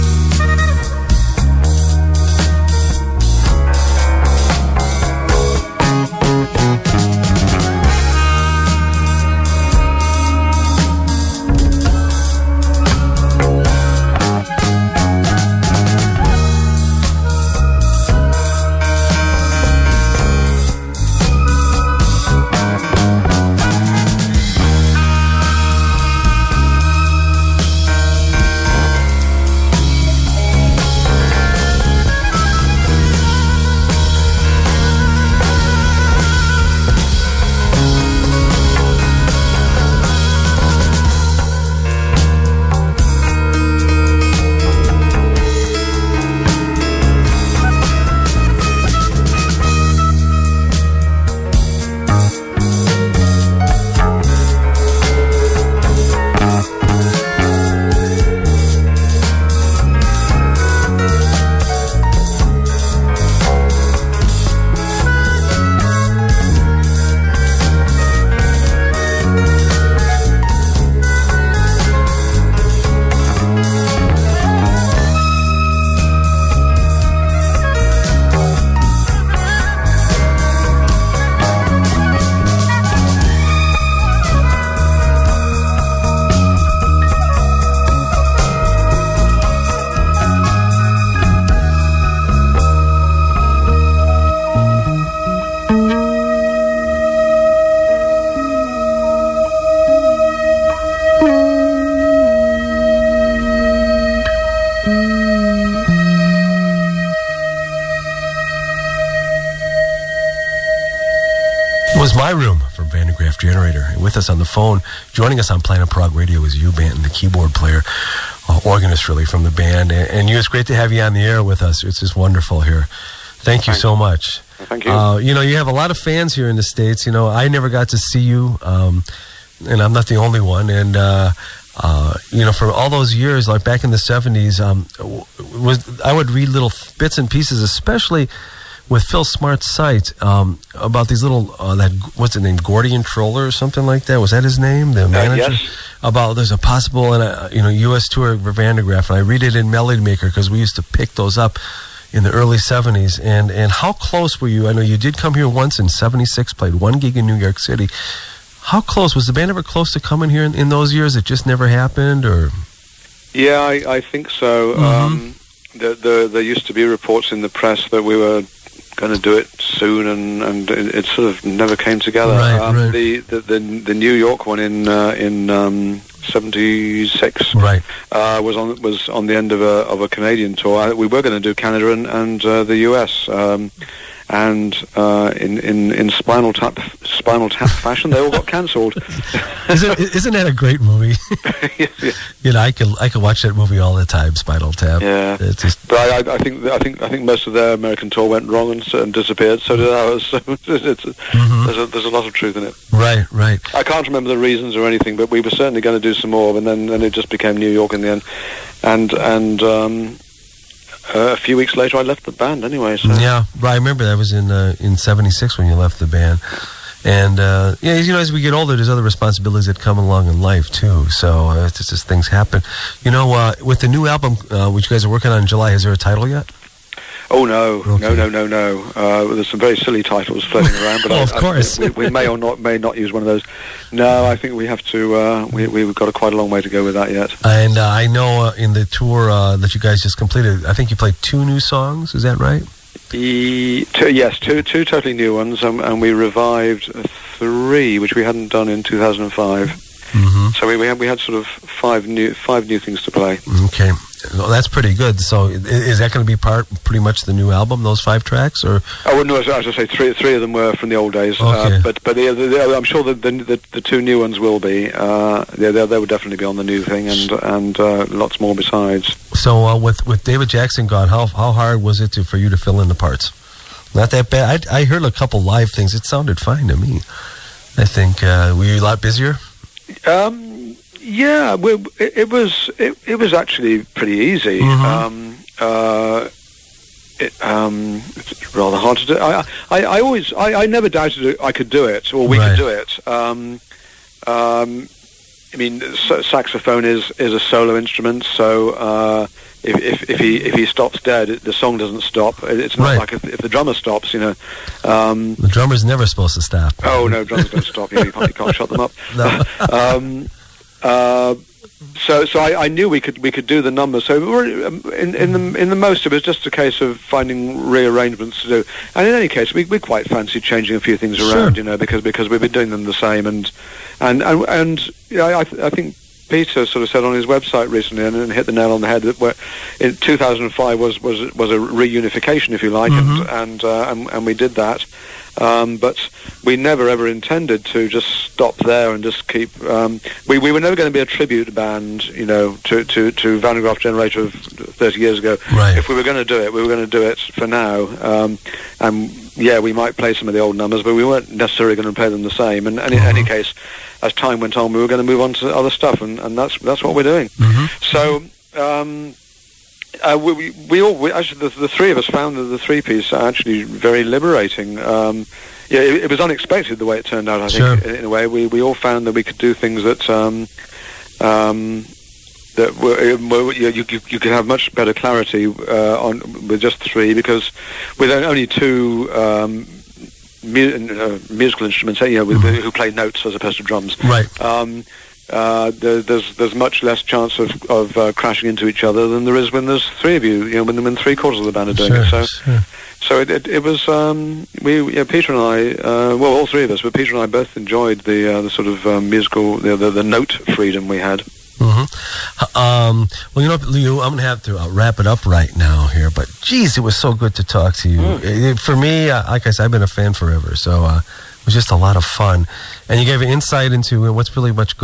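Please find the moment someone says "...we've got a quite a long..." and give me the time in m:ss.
3:55.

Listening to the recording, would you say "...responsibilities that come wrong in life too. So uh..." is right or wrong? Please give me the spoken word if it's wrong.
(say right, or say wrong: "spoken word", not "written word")
wrong: "along", not "wrong".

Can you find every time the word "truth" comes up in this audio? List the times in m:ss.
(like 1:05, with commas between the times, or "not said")
3:22.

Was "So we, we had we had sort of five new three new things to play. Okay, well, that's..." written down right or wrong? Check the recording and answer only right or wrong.
wrong.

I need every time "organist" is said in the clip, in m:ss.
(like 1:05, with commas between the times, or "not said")
1:58.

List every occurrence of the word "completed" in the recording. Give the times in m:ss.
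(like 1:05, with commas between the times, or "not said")
4:00.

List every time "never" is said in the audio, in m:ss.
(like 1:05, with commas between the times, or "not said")
2:07, 2:41, 2:51, 4:50, 5:05, 5:36, 5:40.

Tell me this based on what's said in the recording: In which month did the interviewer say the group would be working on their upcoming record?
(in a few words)
July.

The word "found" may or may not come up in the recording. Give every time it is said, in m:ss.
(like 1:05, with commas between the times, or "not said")
6:02, 6:08.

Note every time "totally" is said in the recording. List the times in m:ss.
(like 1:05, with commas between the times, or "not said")
4:04.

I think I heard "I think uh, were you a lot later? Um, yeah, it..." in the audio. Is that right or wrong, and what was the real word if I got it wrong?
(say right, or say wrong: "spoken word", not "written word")
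wrong: "busier", not "later".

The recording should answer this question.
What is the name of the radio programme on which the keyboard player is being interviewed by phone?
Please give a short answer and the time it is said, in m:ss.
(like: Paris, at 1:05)
Planet Prog Radio, at 1:55.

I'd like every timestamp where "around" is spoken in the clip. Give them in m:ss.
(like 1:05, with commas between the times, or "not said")
3:50, 5:21.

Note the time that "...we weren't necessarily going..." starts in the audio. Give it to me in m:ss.
5:50.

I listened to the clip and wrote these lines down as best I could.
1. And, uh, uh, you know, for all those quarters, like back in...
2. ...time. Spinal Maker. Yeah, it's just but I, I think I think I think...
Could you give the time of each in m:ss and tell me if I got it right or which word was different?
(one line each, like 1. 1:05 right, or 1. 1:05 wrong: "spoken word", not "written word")
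1. 2:10 wrong: "years", not "quarters"
2. 3:14 wrong: "Tap", not "Maker".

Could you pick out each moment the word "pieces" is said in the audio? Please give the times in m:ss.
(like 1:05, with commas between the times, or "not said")
2:17, 6:02.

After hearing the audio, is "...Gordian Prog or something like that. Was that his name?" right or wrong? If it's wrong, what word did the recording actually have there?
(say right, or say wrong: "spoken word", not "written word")
wrong: "Troeller", not "Prog".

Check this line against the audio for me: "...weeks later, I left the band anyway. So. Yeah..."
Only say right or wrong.
right.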